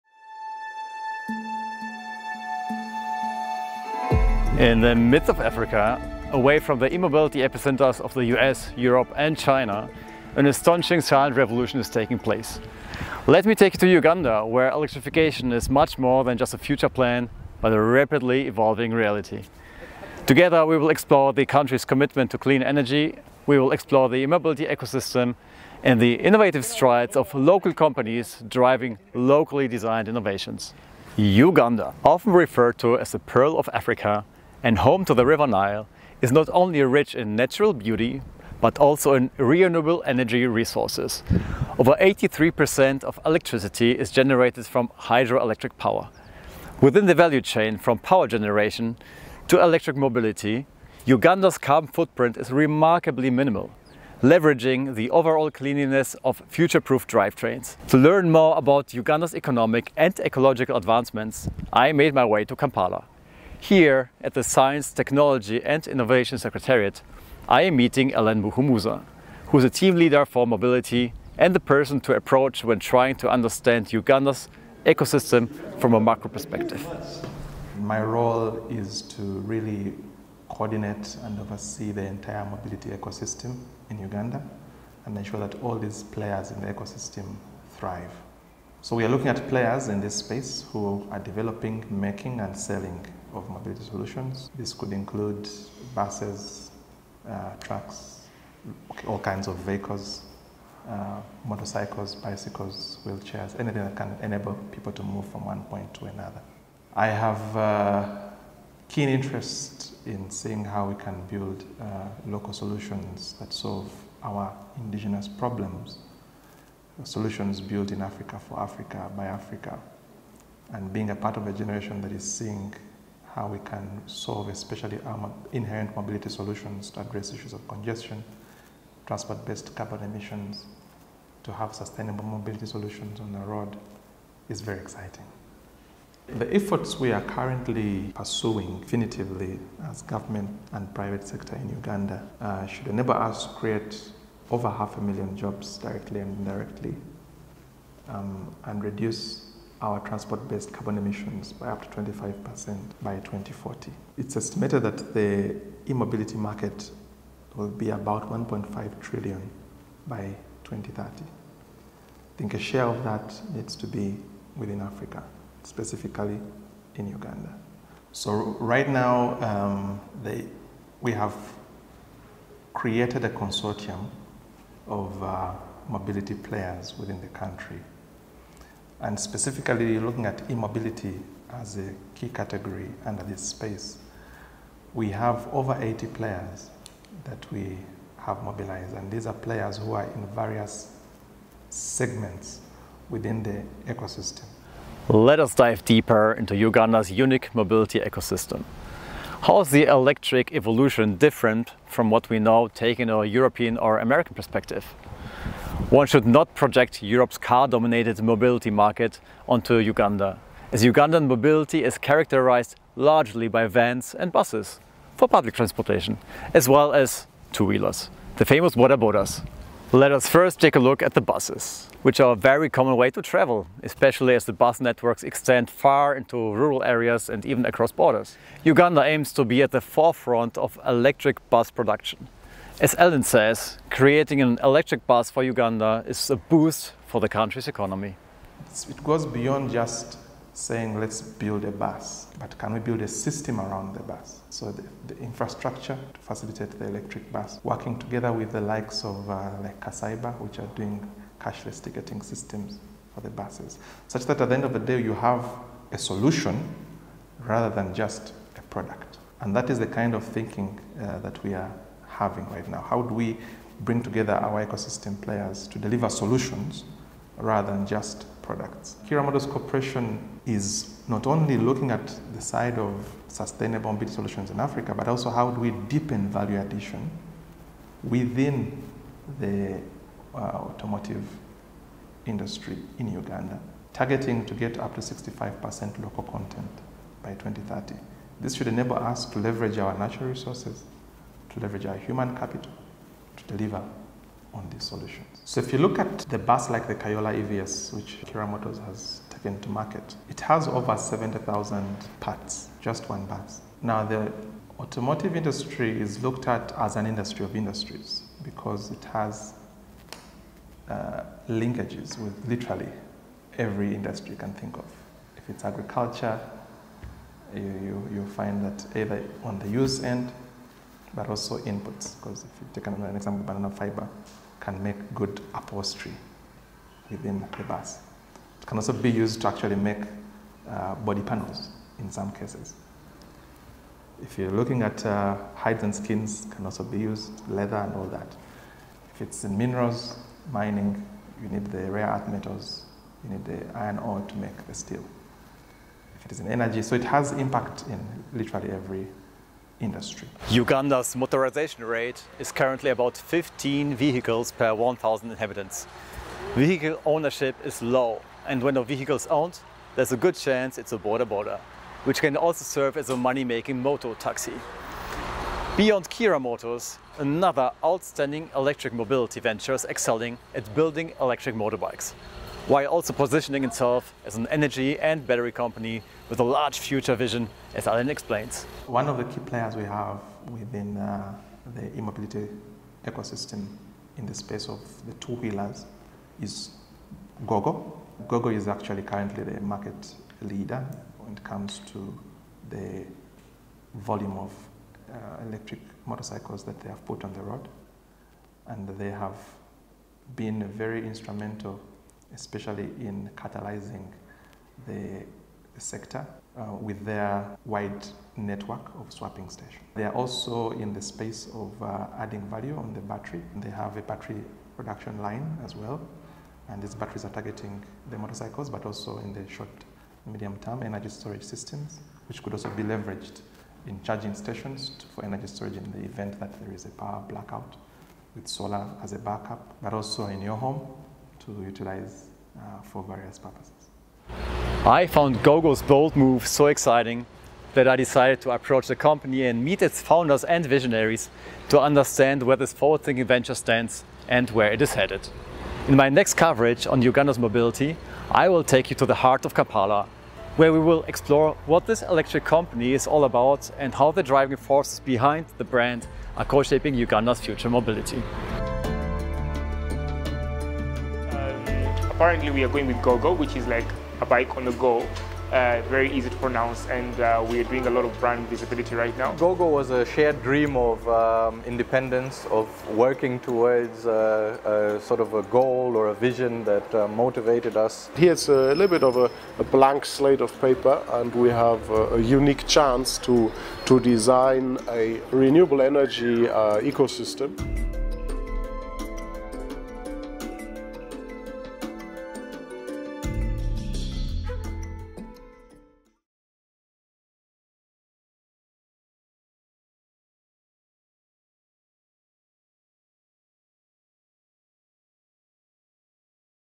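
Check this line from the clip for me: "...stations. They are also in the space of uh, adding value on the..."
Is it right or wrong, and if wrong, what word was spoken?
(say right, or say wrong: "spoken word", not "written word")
right.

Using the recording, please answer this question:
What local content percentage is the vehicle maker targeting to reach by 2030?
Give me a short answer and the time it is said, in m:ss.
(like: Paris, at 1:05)
65%, at 4:45.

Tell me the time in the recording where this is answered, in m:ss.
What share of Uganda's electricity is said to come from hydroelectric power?
0:41.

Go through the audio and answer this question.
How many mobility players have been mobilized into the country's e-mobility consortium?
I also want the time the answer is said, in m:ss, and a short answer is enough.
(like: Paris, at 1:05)
Over 80, at 3:05.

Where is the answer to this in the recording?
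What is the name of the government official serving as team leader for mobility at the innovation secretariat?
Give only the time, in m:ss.
1:08.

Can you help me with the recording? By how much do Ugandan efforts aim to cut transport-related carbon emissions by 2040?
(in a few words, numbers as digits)
Up to 25%.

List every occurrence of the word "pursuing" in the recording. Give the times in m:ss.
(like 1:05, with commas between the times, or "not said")
2:18.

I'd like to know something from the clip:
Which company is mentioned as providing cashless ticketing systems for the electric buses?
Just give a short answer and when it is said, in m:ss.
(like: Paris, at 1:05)
Kasaiba, at 4:09.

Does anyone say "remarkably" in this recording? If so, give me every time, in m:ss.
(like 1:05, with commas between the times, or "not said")
0:52.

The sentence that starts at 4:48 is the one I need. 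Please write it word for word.
This should enable us to leverage our natural resources to leverage our human capital to deliver on these solutions.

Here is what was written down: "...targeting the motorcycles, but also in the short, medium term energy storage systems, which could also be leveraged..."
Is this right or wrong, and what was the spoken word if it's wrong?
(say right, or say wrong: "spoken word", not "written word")
right.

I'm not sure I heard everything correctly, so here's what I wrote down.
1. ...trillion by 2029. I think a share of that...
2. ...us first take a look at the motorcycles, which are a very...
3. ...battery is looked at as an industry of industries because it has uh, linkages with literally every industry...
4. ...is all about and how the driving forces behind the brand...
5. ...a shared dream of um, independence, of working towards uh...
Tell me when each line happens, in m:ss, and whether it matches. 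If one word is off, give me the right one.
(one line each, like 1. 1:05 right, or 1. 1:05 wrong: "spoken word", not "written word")
1. 2:39 wrong: "2030", not "2029"
2. 3:40 wrong: "buses", not "motorcycles"
3. 5:05 wrong: "industry", not "battery"
4. 7:32 right
5. 7:49 right.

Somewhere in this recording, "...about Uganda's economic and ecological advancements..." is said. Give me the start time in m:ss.
0:58.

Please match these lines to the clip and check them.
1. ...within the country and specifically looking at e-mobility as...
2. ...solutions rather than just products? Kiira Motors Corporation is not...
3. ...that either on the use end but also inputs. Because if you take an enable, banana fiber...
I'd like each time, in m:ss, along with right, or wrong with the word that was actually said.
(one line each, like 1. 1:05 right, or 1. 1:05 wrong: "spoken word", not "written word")
1. 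2:56 right
2. 4:26 right
3. 5:18 wrong: "example", not "enable".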